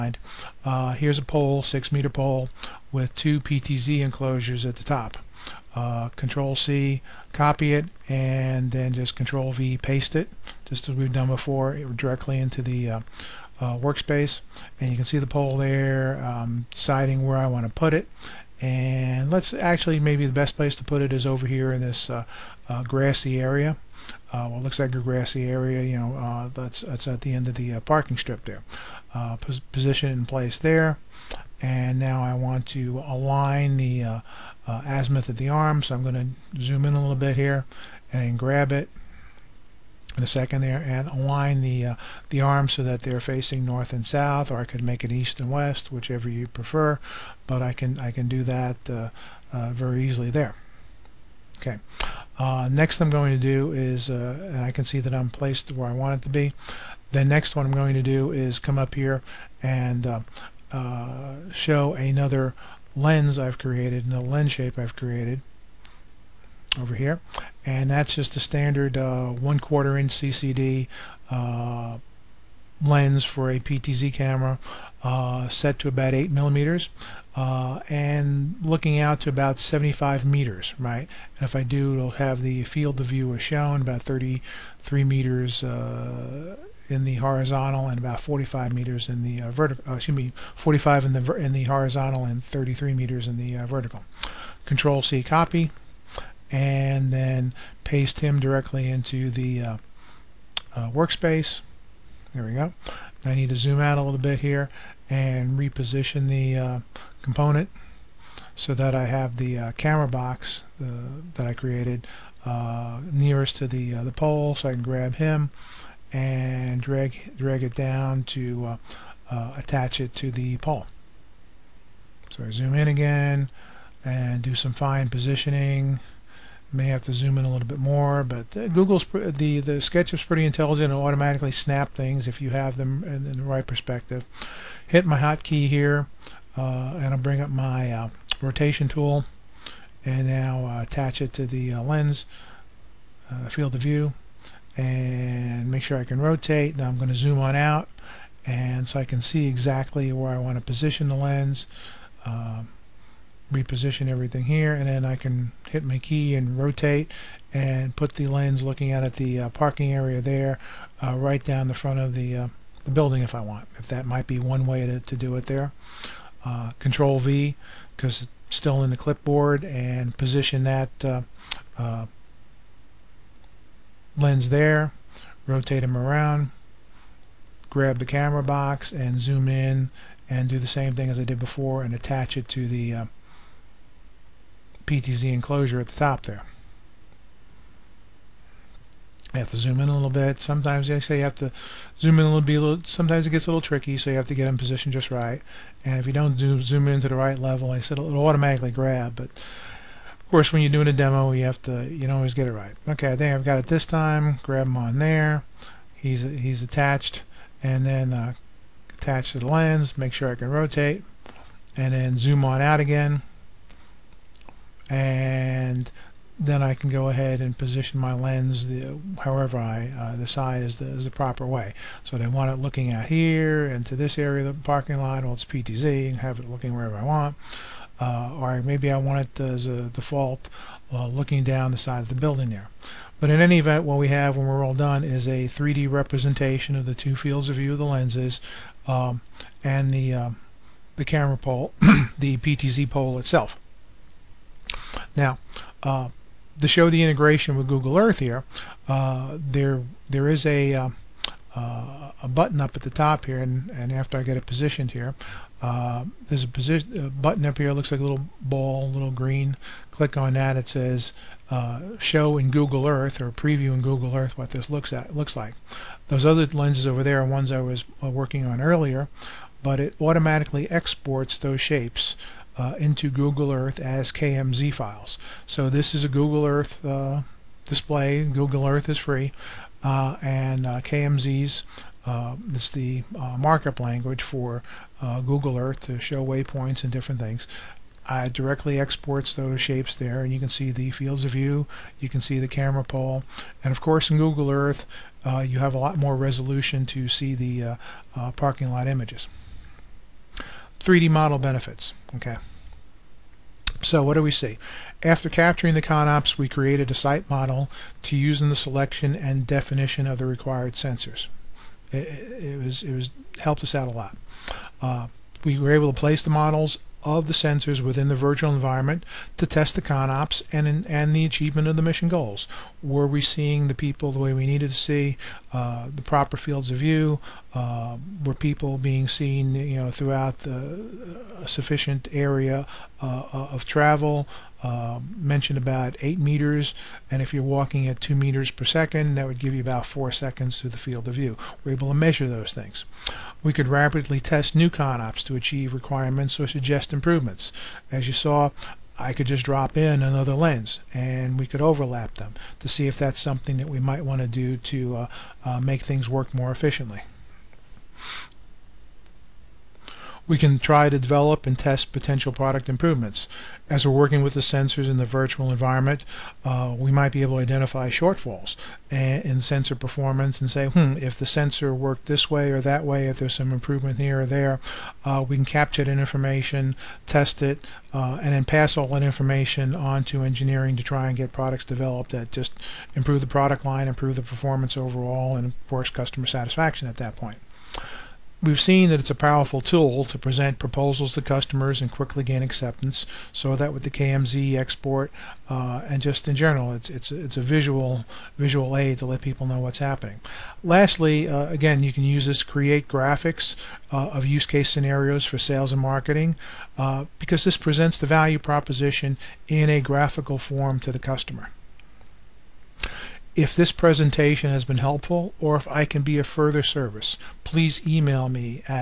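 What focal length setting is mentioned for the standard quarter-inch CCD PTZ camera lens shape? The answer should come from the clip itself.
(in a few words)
8 millimeters.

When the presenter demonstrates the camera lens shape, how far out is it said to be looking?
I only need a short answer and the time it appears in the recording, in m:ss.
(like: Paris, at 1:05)
75 meters, at 1:19.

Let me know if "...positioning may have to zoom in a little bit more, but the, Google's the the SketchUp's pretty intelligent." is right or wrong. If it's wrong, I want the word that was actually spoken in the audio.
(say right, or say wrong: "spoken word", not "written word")
right.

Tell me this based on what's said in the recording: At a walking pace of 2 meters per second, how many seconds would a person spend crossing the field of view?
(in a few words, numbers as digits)
4 seconds.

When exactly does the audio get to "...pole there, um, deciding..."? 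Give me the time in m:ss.
0:15.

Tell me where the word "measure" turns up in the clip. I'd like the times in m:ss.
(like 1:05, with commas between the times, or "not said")
5:41.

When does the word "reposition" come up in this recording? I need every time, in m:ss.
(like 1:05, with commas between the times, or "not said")
1:45, 2:33.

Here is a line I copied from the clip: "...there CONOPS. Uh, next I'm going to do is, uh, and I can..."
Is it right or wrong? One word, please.
wrong.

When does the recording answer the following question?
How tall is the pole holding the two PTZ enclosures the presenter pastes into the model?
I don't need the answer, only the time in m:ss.
0:01.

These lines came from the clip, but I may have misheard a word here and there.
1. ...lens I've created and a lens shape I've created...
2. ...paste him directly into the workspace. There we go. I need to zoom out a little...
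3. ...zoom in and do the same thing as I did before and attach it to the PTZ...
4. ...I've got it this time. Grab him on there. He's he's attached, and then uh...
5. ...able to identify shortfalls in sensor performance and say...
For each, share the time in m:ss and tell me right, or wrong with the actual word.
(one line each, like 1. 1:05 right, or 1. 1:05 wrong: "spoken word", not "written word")
1. 1:02 right
2. 1:37 right
3. 2:59 right
4. 3:23 right
5. 6:07 right.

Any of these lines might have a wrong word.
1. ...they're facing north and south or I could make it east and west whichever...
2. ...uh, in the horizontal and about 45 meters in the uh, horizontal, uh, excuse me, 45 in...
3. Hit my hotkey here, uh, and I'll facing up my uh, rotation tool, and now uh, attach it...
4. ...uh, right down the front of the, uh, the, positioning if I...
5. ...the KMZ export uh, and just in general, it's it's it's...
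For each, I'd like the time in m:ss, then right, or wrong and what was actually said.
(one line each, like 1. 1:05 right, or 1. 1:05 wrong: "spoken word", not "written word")
1. 0:43 right
2. 1:25 wrong: "vertical", not "horizontal"
3. 2:14 wrong: "bring", not "facing"
4. 2:41 wrong: "building", not "positioning"
5. 6:33 right.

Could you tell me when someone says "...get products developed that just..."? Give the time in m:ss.
6:21.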